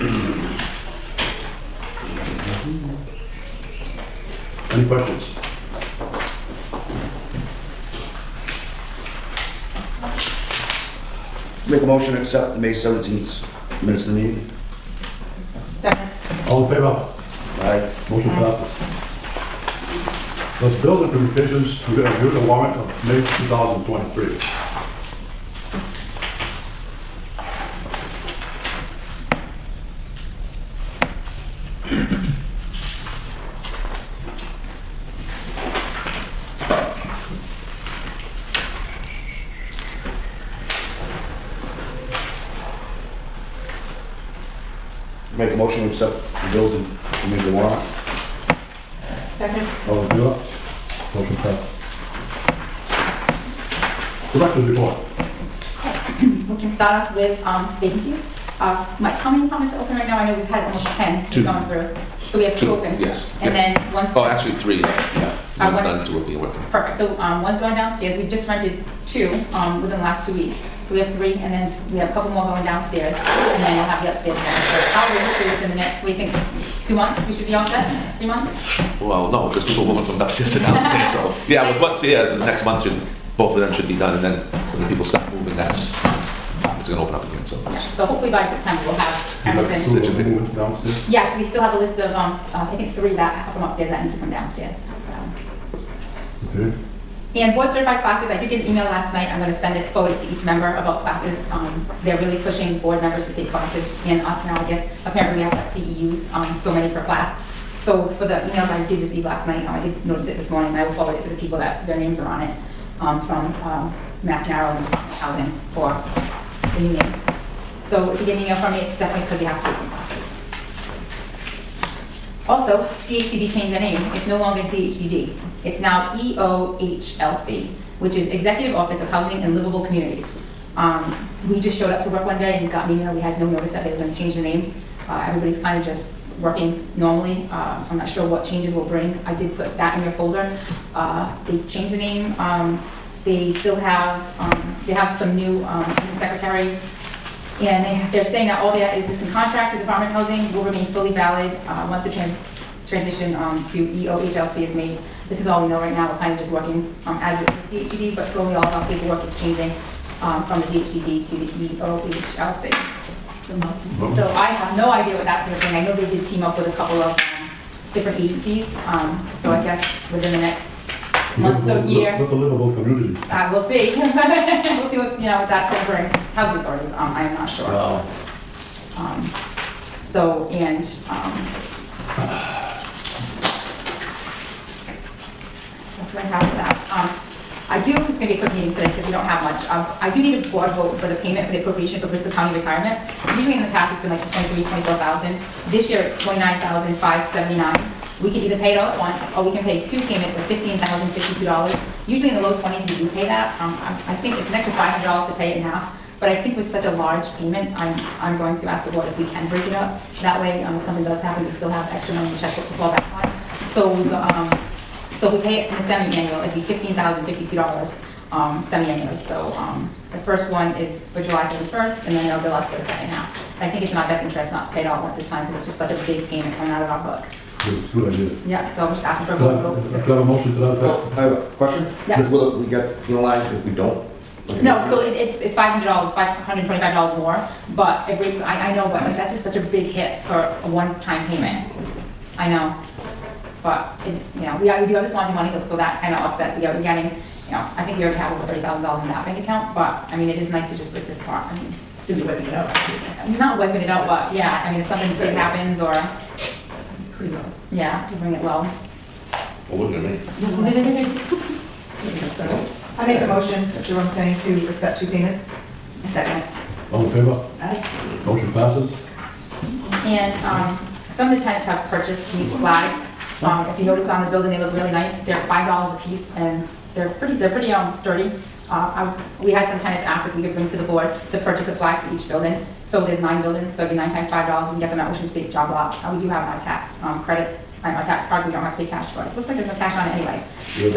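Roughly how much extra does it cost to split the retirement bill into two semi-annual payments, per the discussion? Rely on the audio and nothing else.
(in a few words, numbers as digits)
$525.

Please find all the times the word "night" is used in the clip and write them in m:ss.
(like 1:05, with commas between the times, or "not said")
1:39, 1:49.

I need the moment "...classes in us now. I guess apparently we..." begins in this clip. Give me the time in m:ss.
1:43.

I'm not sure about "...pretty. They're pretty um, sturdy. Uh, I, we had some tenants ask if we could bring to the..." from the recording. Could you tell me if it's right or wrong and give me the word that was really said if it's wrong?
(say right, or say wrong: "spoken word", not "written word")
right.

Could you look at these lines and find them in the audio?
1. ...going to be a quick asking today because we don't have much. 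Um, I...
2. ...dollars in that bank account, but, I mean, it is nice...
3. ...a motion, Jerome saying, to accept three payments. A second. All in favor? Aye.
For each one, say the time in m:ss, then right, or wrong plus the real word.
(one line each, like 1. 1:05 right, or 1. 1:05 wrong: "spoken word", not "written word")
1. 3:08 wrong: "meeting", not "asking"
2. 4:08 right
3. 4:23 wrong: "two", not "three".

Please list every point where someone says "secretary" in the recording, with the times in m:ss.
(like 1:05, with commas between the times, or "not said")
2:26.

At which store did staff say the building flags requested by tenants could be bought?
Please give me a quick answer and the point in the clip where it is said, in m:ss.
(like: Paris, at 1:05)
Ocean State Job Lot, at 4:45.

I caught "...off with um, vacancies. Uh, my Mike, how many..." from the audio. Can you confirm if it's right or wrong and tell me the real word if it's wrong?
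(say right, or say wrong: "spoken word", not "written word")
right.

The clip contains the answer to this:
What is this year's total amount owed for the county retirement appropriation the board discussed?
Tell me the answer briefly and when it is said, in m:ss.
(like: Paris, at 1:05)
29,579, at 3:16.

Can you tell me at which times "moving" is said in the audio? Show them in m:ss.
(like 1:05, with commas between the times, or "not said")
1:19, 1:25.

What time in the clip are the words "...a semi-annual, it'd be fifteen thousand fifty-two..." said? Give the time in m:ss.
3:35.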